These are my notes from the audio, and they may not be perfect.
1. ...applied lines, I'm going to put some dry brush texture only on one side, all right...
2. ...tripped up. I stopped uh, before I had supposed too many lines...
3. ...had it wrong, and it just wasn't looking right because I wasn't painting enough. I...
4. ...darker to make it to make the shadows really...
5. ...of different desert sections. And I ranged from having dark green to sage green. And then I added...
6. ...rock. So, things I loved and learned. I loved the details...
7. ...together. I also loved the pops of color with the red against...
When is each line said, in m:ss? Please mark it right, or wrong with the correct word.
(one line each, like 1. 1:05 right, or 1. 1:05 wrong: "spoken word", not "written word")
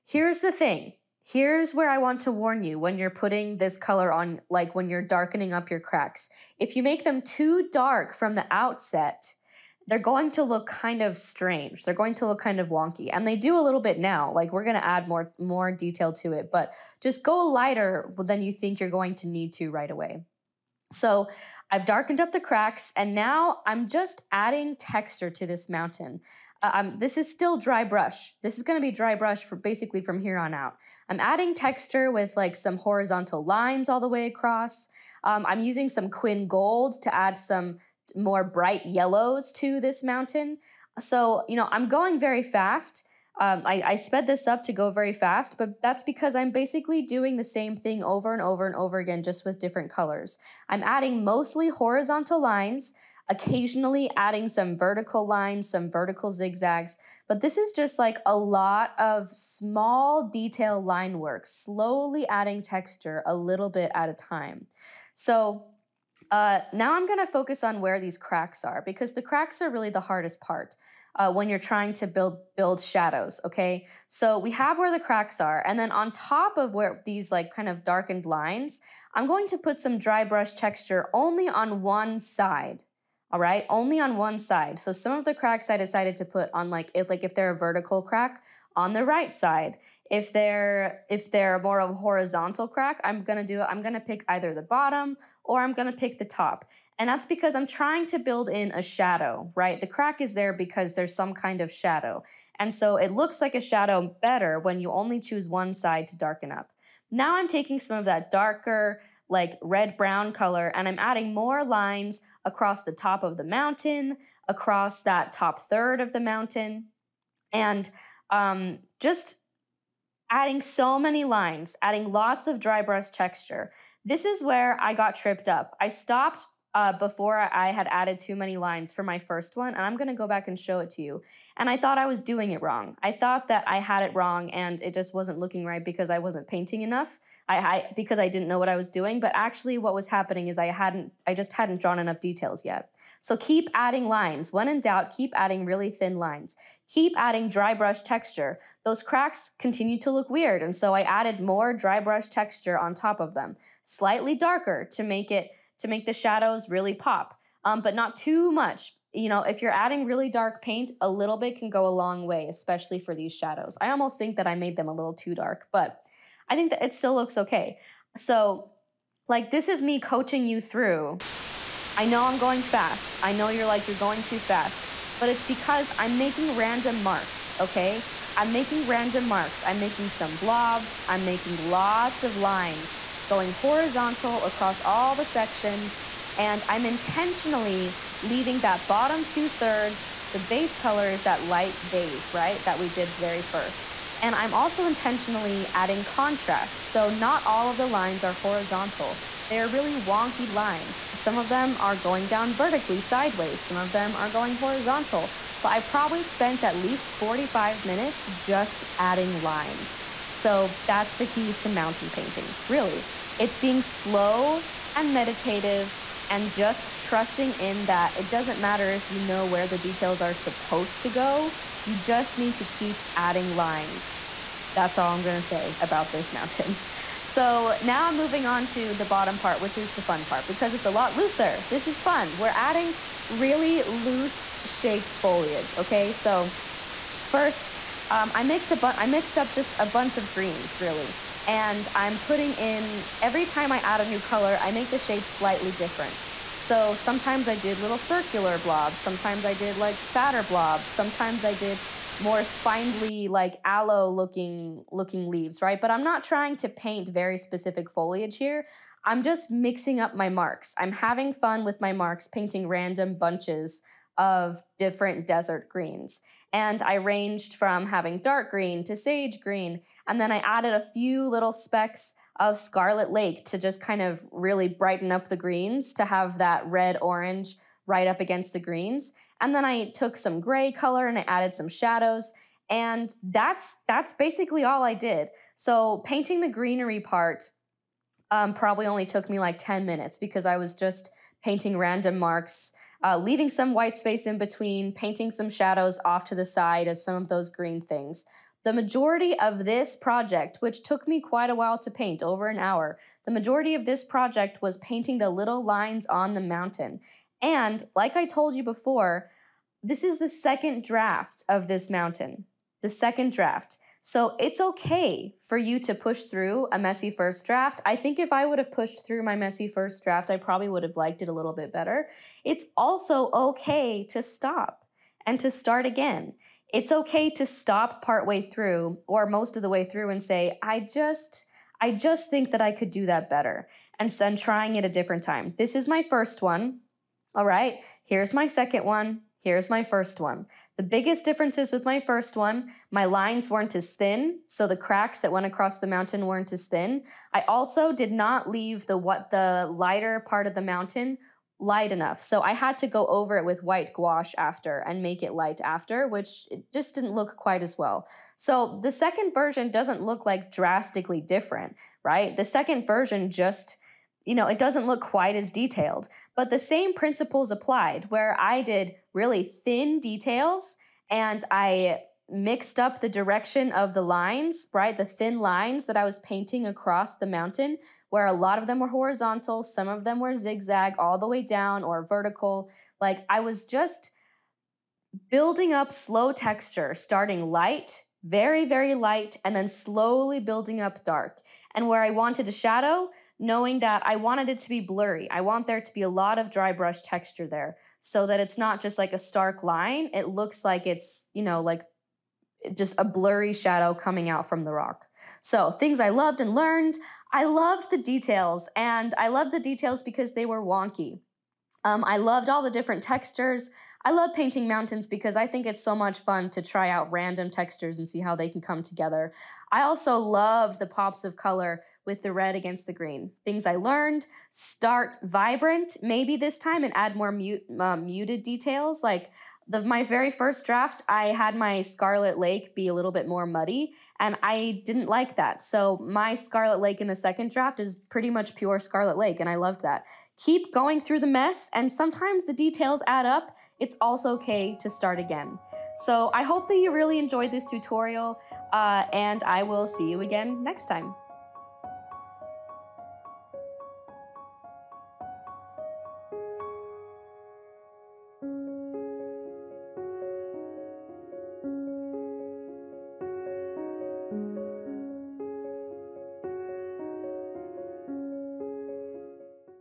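1. 1:17 wrong: "darkened", not "applied"
2. 2:05 wrong: "added", not "supposed"
3. 2:13 right
4. 2:34 right
5. 4:24 wrong: "greens", not "sections"
6. 6:44 right
7. 6:58 right.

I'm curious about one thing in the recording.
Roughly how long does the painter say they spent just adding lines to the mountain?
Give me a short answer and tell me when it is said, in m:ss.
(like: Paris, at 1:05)
45 minutes, at 3:27.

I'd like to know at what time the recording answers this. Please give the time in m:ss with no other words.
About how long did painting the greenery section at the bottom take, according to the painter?
4:49.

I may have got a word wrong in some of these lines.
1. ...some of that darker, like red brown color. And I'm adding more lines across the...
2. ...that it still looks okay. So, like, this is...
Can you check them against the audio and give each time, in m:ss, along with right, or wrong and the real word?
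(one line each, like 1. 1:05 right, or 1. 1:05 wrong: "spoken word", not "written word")
1. 1:47 right
2. 2:46 right.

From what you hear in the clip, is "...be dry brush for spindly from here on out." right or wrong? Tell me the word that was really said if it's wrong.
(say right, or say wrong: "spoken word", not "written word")
wrong: "basically", not "spindly".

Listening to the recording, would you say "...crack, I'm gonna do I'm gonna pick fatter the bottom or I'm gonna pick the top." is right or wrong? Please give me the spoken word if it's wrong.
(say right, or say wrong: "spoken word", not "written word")
wrong: "either", not "fatter".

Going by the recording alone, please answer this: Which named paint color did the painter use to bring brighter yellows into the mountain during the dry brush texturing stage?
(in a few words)
Quin Gold.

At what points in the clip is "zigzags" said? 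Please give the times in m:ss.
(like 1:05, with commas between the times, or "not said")
0:56, 6:20.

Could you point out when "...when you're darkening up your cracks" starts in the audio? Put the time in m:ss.
0:04.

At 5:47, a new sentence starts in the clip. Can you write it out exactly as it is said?
I also did not leave the what the lighter part of the mountain light enough.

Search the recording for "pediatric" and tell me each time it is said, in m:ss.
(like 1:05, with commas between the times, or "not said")
not said.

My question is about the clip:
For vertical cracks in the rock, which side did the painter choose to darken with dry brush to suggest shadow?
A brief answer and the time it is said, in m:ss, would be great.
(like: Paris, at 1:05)
right side, at 1:29.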